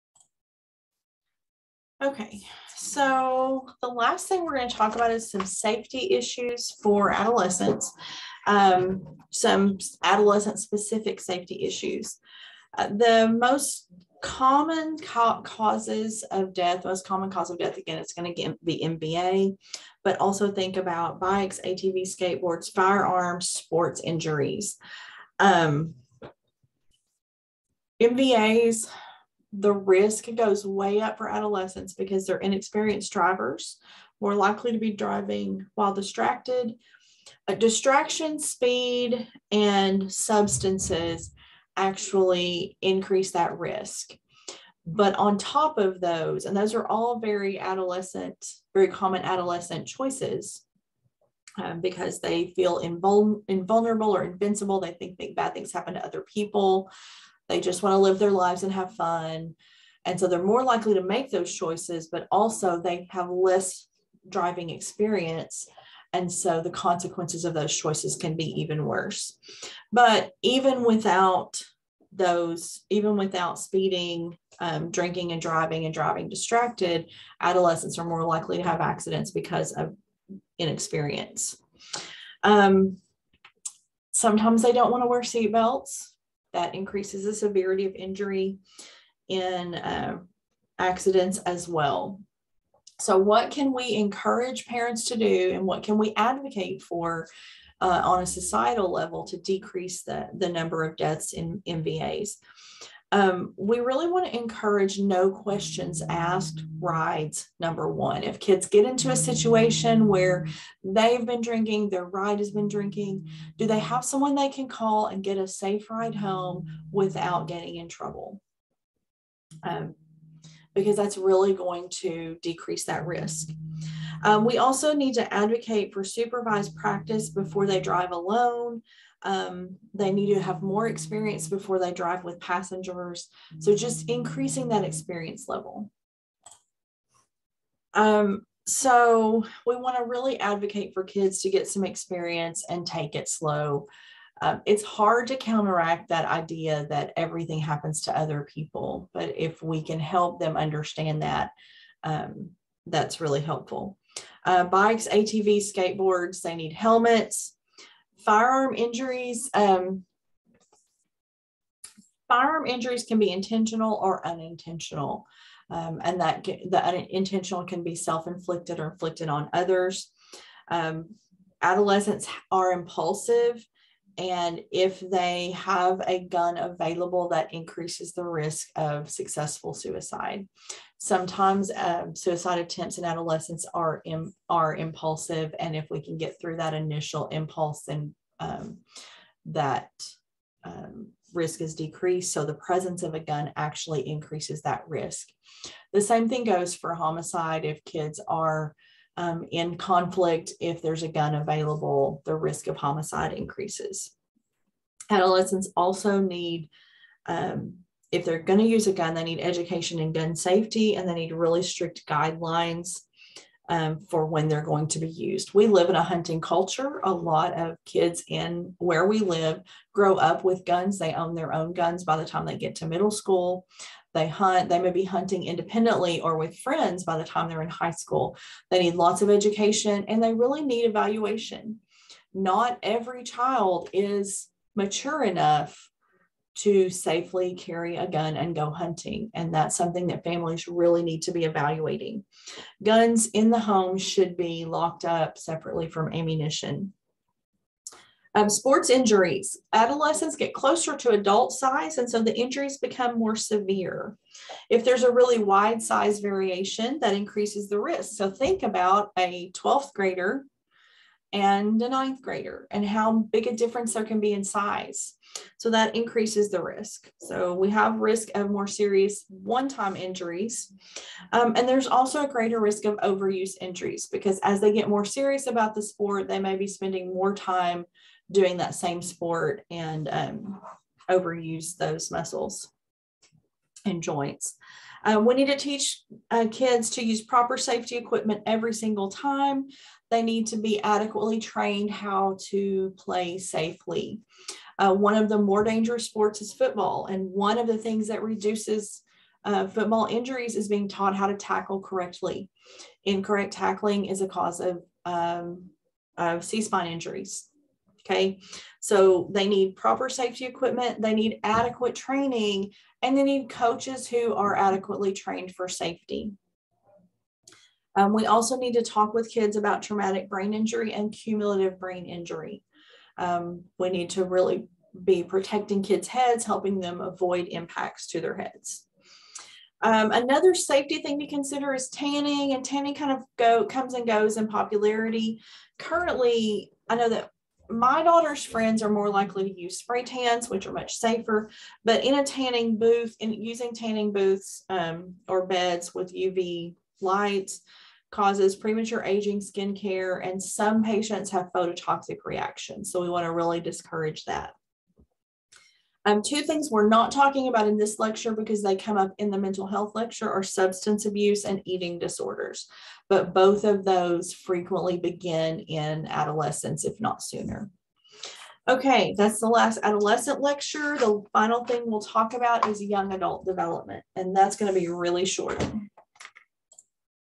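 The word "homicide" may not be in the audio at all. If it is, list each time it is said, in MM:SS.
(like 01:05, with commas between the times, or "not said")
03:16, 03:22.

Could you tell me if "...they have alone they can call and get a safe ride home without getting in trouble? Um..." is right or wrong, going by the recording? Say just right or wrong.
wrong.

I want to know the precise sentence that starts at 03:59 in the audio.
And that's something that families really need to be evaluating.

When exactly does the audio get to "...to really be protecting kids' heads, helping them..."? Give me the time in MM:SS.
05:24.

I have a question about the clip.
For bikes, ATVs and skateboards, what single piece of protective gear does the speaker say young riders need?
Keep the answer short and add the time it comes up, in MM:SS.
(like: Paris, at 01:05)
Helmets, at 02:36.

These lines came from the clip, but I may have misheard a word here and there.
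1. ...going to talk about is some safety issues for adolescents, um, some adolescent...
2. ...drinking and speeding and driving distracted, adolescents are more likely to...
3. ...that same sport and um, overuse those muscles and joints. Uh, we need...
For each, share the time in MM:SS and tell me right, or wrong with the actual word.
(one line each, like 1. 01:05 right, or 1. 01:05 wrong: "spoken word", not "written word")
1. 00:04 right
2. 01:14 wrong: "driving", not "speeding"
3. 04:38 right.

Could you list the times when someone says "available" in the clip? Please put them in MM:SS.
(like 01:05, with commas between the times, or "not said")
02:56, 03:21.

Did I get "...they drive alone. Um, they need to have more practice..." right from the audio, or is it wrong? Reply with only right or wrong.
wrong.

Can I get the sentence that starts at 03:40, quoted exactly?
They own their own guns by the time they get to middle school.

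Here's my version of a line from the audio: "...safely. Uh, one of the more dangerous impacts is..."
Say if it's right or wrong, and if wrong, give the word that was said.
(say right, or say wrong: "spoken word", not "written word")
wrong: "sports", not "impacts".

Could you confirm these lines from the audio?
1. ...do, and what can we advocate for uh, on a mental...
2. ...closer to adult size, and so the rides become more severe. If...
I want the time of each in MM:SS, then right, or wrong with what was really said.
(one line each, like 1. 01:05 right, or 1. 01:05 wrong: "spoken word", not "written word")
1. 01:35 wrong: "societal", not "mental"
2. 04:10 wrong: "injuries", not "rides".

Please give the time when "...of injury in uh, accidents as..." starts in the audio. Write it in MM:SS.
01:27.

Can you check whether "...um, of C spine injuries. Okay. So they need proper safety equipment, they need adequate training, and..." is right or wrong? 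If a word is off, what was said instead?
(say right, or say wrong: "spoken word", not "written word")
right.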